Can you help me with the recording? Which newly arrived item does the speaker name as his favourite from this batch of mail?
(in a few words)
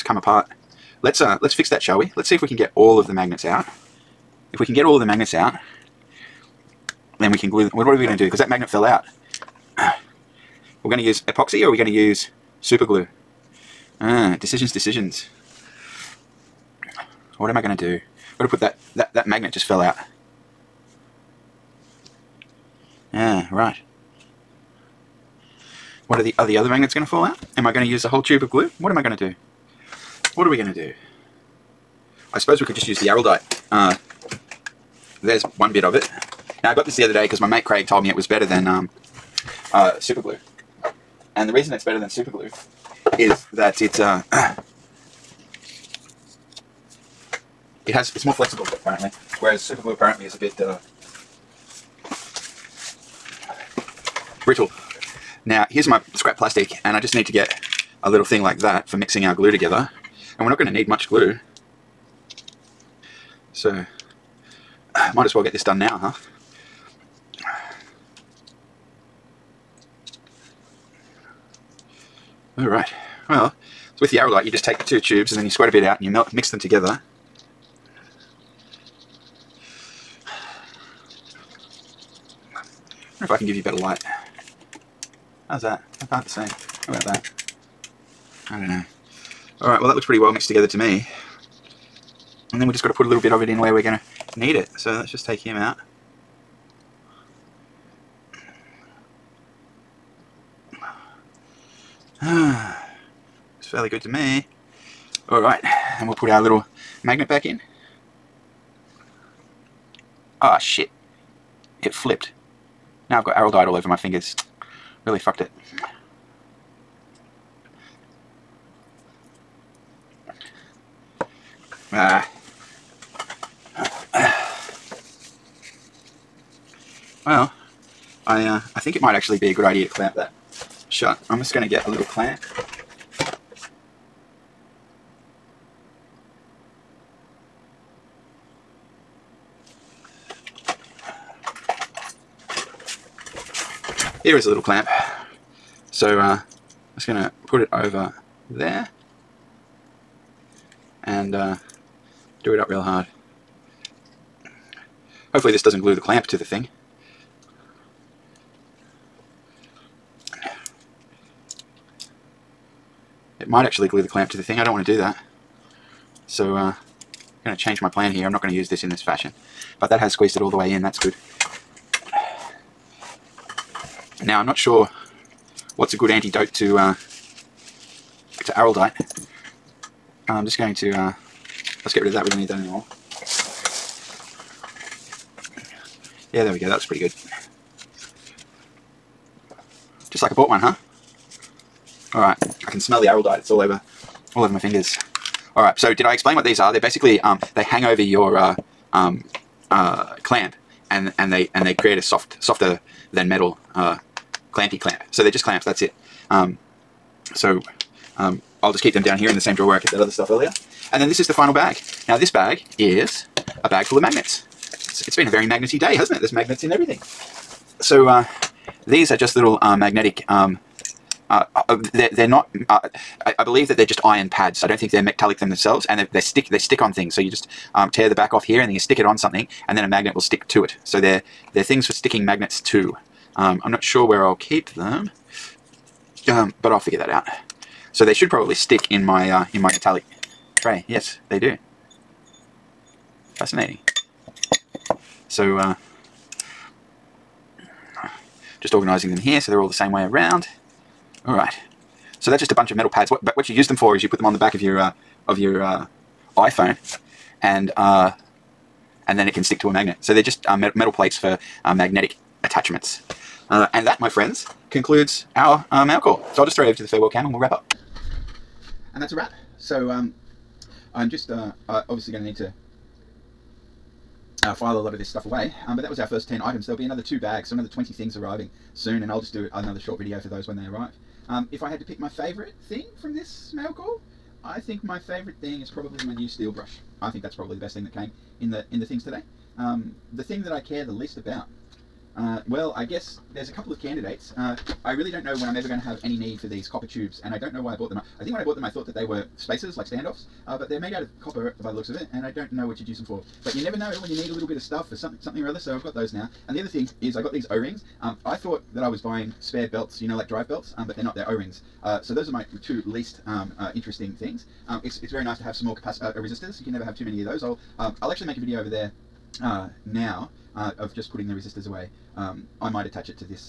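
Steel brush.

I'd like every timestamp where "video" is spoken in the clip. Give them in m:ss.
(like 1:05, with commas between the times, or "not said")
4:39, 5:18.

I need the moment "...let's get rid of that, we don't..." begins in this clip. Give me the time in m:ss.
3:01.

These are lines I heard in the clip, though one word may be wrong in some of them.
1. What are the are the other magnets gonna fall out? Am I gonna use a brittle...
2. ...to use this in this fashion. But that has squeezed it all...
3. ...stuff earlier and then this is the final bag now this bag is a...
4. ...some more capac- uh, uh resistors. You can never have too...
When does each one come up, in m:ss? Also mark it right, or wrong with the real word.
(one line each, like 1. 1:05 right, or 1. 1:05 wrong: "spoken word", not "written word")
1. 0:26 wrong: "whole", not "brittle"
2. 2:48 right
3. 3:30 right
4. 5:15 right.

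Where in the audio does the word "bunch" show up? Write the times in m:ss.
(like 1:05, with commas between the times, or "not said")
4:12.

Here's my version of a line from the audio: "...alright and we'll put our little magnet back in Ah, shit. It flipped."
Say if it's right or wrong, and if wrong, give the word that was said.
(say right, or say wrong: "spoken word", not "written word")
right.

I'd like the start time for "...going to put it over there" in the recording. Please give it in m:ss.
2:27.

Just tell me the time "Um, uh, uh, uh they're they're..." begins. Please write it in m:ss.
3:40.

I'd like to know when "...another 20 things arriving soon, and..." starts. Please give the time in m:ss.
4:37.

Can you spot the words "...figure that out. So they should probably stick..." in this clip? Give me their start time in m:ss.
3:56.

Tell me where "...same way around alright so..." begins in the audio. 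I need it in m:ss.
4:09.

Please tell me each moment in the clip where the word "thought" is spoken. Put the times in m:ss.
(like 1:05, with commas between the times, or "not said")
4:58, 5:08.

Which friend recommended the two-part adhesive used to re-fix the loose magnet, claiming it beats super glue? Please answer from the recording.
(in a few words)
Craig.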